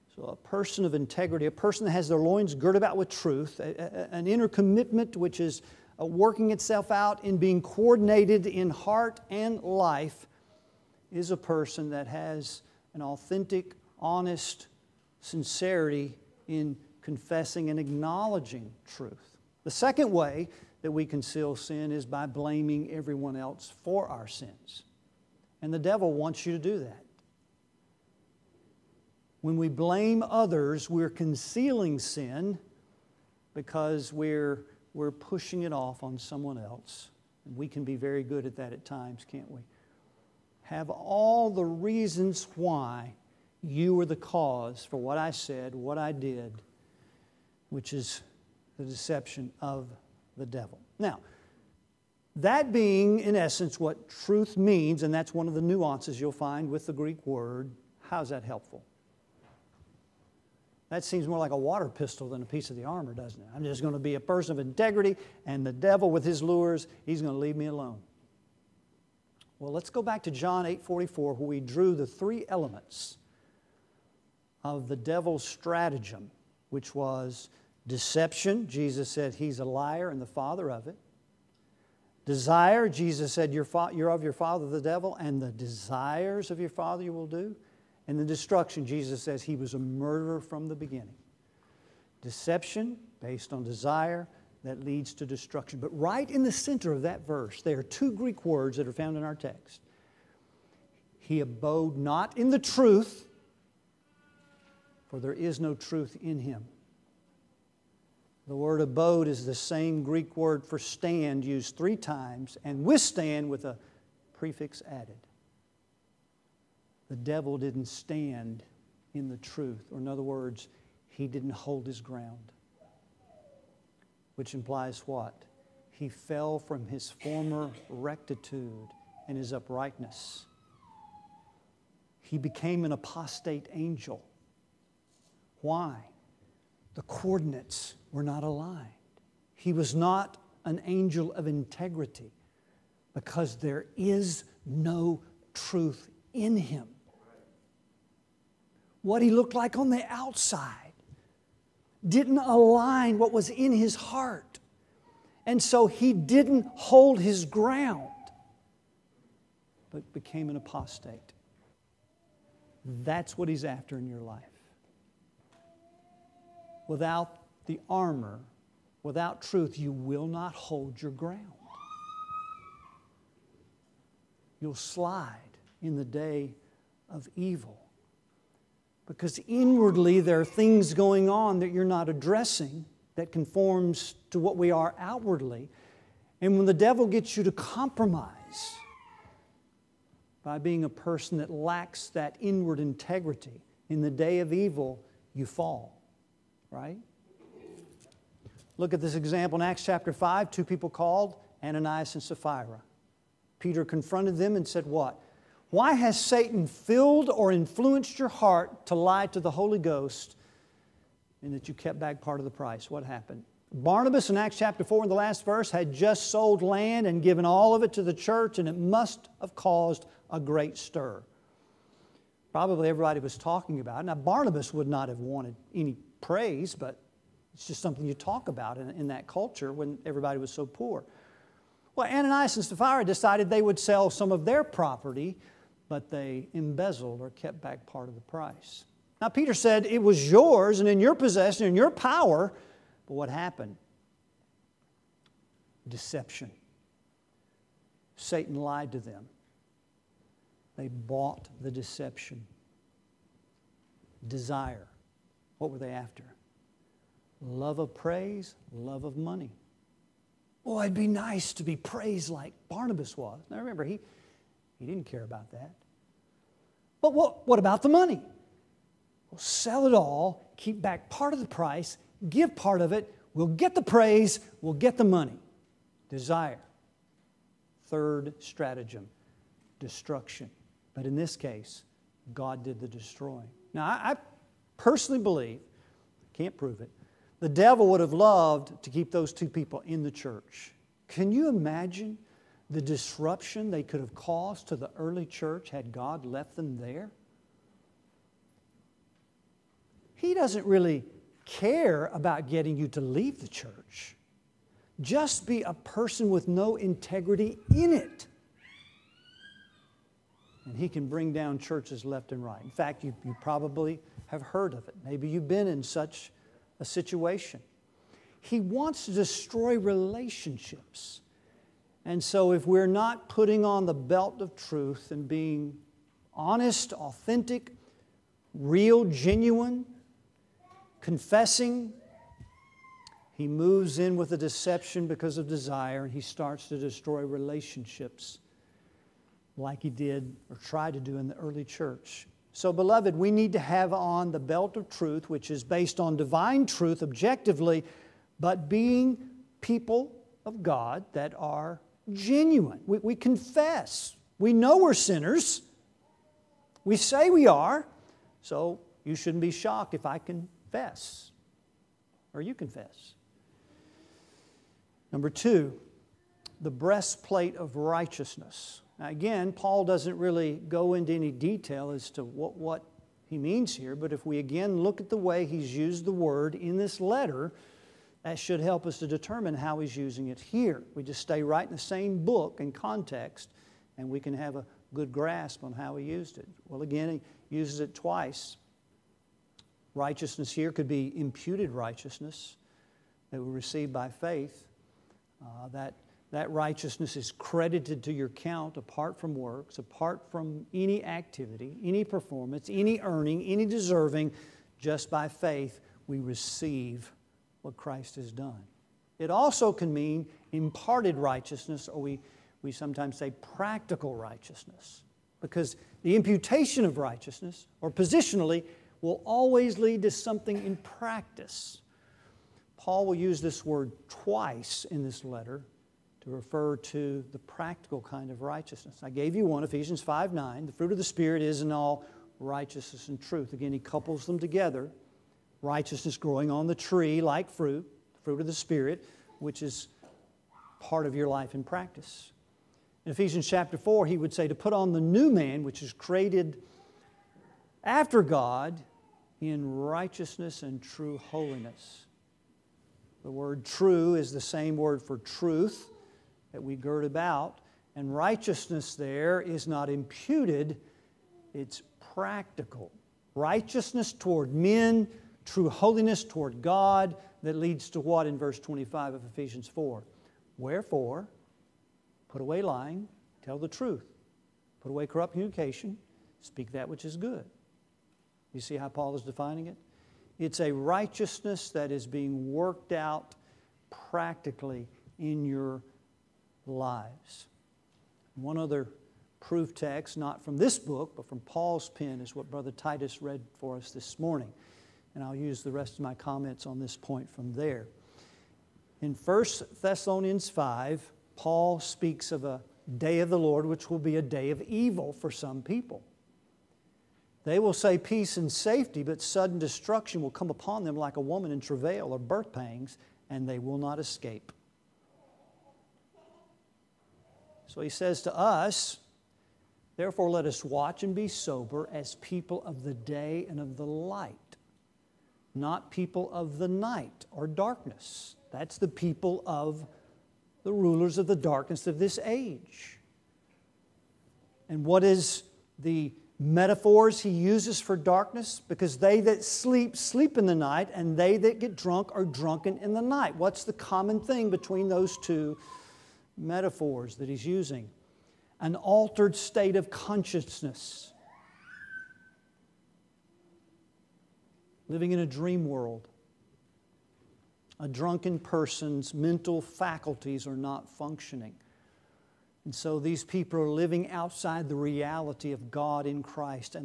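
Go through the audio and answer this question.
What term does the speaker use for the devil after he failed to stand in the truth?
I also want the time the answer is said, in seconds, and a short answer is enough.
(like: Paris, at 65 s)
apostate angel, at 132 s.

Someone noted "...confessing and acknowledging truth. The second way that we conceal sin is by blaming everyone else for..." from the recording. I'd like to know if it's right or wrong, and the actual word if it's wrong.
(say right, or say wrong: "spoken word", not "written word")
right.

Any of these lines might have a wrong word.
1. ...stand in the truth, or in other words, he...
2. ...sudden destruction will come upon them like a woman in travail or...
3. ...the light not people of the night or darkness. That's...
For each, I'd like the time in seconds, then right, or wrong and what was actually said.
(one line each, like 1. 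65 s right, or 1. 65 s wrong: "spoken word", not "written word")
1. 117 s right
2. 509 s right
3. 523 s right.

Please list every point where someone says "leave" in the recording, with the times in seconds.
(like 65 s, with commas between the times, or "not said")
67 s, 302 s.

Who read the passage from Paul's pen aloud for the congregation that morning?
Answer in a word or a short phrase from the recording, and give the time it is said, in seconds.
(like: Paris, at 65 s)
Brother Titus, at 492 s.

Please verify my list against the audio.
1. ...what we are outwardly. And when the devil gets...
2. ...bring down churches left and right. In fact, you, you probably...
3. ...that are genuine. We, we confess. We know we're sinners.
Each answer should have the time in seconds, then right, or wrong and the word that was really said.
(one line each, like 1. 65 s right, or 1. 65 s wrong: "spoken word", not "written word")
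1. 184 s right
2. 311 s right
3. 351 s right.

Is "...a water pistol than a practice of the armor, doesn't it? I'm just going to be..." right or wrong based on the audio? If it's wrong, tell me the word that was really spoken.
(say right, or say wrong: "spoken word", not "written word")
wrong: "piece", not "practice".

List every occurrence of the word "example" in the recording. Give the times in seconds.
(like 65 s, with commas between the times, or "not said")
199 s.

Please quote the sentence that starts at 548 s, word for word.
An altered state of consciousness living in a dream world.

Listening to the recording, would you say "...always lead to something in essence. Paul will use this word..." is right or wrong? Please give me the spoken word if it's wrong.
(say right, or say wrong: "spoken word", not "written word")
wrong: "practice", not "essence".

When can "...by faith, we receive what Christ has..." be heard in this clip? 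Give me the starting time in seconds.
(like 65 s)
405 s.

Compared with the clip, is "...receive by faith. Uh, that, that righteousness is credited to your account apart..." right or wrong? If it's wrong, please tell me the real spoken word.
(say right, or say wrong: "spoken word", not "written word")
right.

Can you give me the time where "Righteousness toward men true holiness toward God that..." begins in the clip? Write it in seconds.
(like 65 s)
463 s.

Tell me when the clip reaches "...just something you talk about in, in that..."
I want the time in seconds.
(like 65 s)
227 s.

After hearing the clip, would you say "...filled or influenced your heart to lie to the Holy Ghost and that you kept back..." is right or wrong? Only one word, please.
right.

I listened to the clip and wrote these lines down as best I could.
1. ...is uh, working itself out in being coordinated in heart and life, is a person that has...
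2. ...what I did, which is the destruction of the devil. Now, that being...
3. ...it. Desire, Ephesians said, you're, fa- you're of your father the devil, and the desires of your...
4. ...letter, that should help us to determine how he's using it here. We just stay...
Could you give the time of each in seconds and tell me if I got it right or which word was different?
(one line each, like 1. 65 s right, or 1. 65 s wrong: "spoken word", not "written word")
1. 5 s right
2. 45 s wrong: "deception", not "destruction"
3. 80 s wrong: "Jesus", not "Ephesians"
4. 376 s right.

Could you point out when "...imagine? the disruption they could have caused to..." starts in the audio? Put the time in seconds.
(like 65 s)
291 s.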